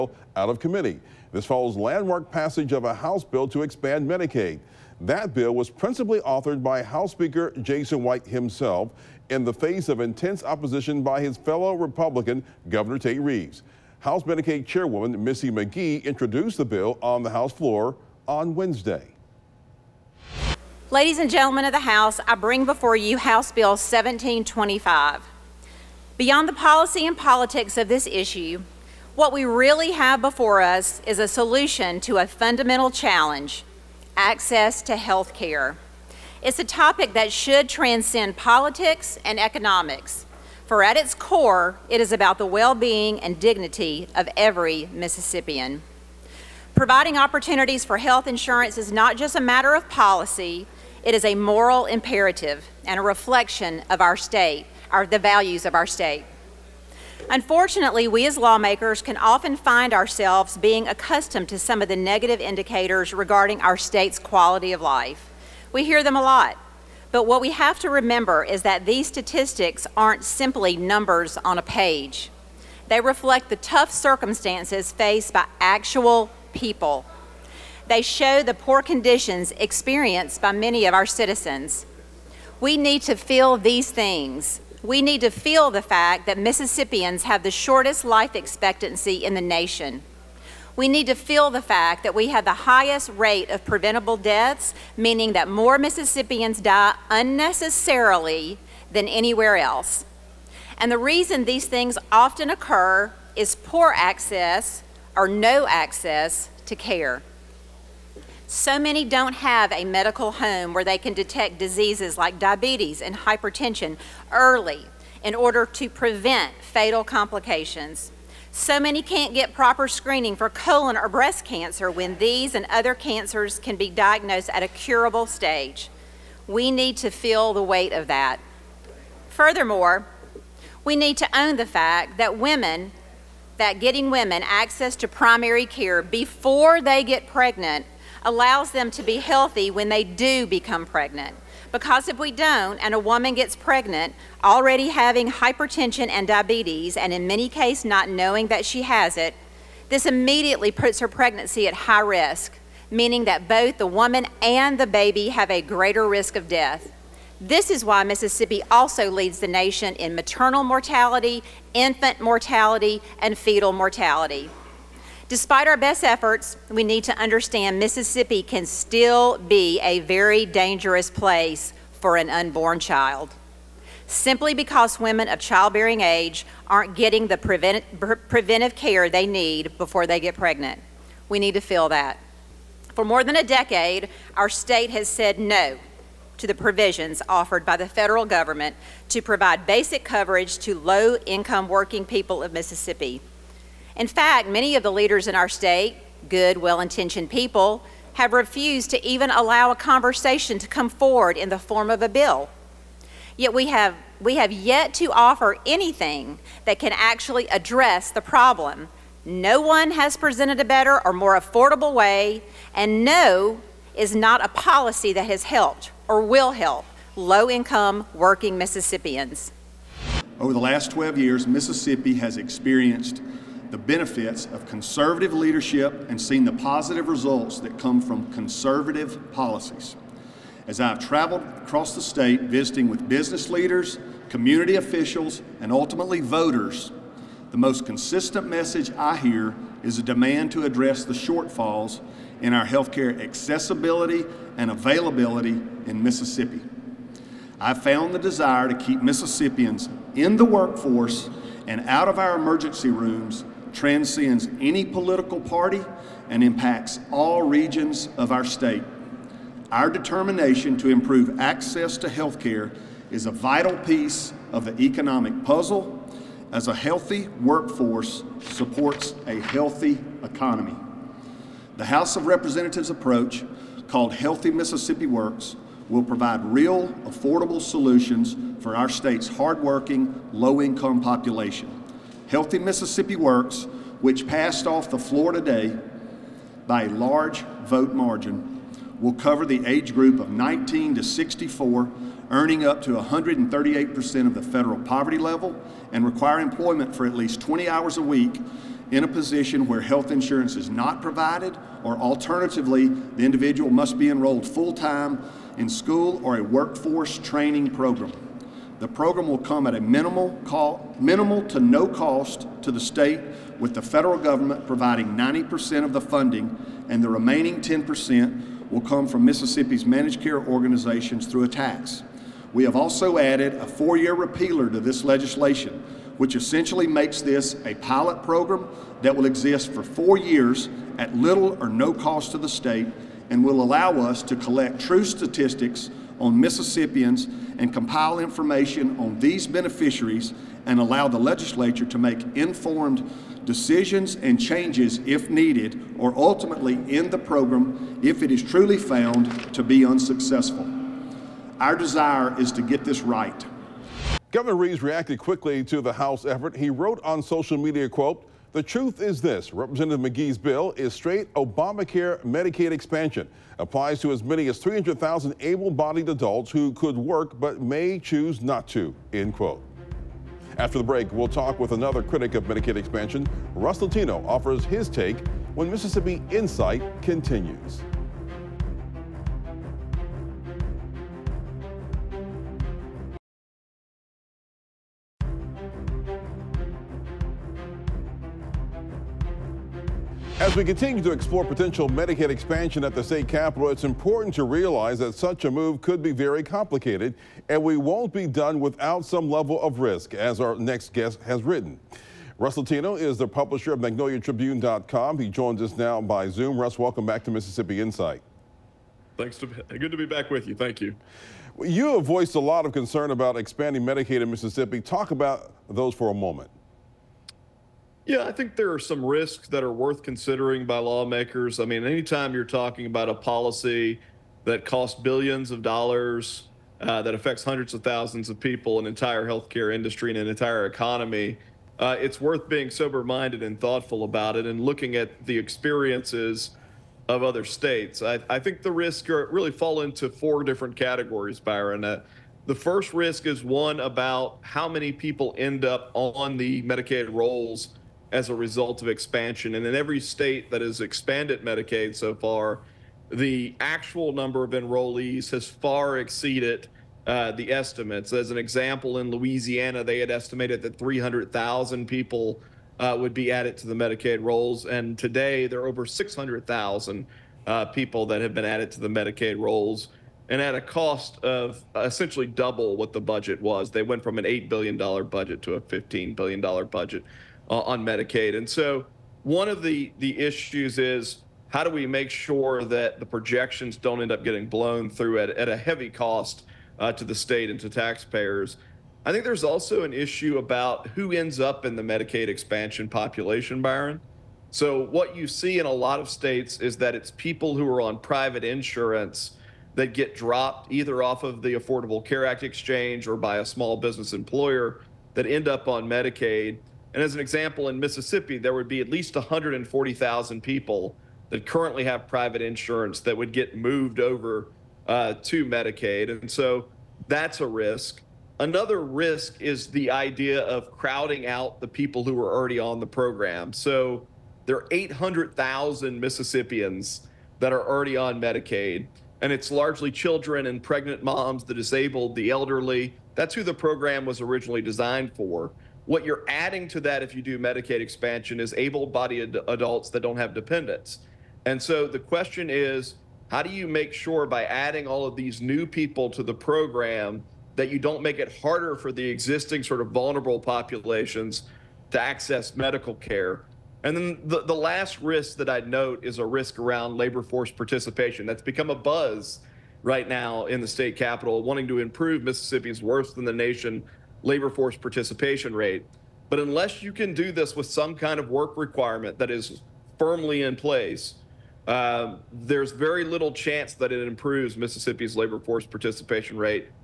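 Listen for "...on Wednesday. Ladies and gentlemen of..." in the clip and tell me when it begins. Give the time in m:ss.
0:18.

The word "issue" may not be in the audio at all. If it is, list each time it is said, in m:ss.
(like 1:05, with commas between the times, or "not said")
0:28, 8:00, 8:09.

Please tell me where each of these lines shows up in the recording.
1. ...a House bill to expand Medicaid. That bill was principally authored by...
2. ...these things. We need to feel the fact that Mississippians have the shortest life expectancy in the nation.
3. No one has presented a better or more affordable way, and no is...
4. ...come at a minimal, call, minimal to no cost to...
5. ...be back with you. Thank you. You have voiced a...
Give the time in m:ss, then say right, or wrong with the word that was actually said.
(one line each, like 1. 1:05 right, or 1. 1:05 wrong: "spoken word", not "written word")
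1. 0:02 right
2. 1:23 right
3. 3:29 right
4. 5:09 right
5. 6:49 right.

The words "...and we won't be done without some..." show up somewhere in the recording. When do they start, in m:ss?
6:37.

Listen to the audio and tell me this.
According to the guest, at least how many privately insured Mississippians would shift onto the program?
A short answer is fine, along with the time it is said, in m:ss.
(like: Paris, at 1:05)
140,000, at 8:29.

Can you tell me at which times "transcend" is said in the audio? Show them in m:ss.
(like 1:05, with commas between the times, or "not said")
0:37, 4:13.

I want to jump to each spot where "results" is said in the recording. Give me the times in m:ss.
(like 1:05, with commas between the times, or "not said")
3:47, 7:28.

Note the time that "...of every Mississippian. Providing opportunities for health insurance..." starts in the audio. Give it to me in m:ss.
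0:44.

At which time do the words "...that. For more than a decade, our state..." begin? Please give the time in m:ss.
3:01.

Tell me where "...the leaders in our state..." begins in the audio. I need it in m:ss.
3:14.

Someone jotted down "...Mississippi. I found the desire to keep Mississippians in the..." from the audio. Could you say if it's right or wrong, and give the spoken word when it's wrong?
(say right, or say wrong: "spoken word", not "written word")
right.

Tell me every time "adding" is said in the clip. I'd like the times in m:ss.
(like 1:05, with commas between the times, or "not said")
8:56, 9:04.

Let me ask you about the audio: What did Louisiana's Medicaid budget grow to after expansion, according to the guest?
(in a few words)
$15 billion.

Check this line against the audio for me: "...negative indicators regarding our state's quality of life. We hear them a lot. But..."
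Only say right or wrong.
right.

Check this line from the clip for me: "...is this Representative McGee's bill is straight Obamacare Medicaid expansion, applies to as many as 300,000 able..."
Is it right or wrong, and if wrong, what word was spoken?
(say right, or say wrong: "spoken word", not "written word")
right.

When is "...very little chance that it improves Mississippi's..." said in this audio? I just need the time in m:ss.
9:32.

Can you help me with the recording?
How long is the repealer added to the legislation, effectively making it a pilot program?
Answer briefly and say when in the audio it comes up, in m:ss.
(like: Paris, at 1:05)
4 years, at 5:23.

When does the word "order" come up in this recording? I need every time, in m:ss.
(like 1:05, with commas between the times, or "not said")
1:55.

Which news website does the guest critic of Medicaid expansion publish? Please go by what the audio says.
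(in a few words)
MagnoliaTribune.com.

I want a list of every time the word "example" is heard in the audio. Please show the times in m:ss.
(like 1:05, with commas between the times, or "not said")
7:38, 8:27.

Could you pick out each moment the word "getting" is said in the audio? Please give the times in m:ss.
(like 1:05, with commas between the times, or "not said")
2:13, 2:56, 8:04.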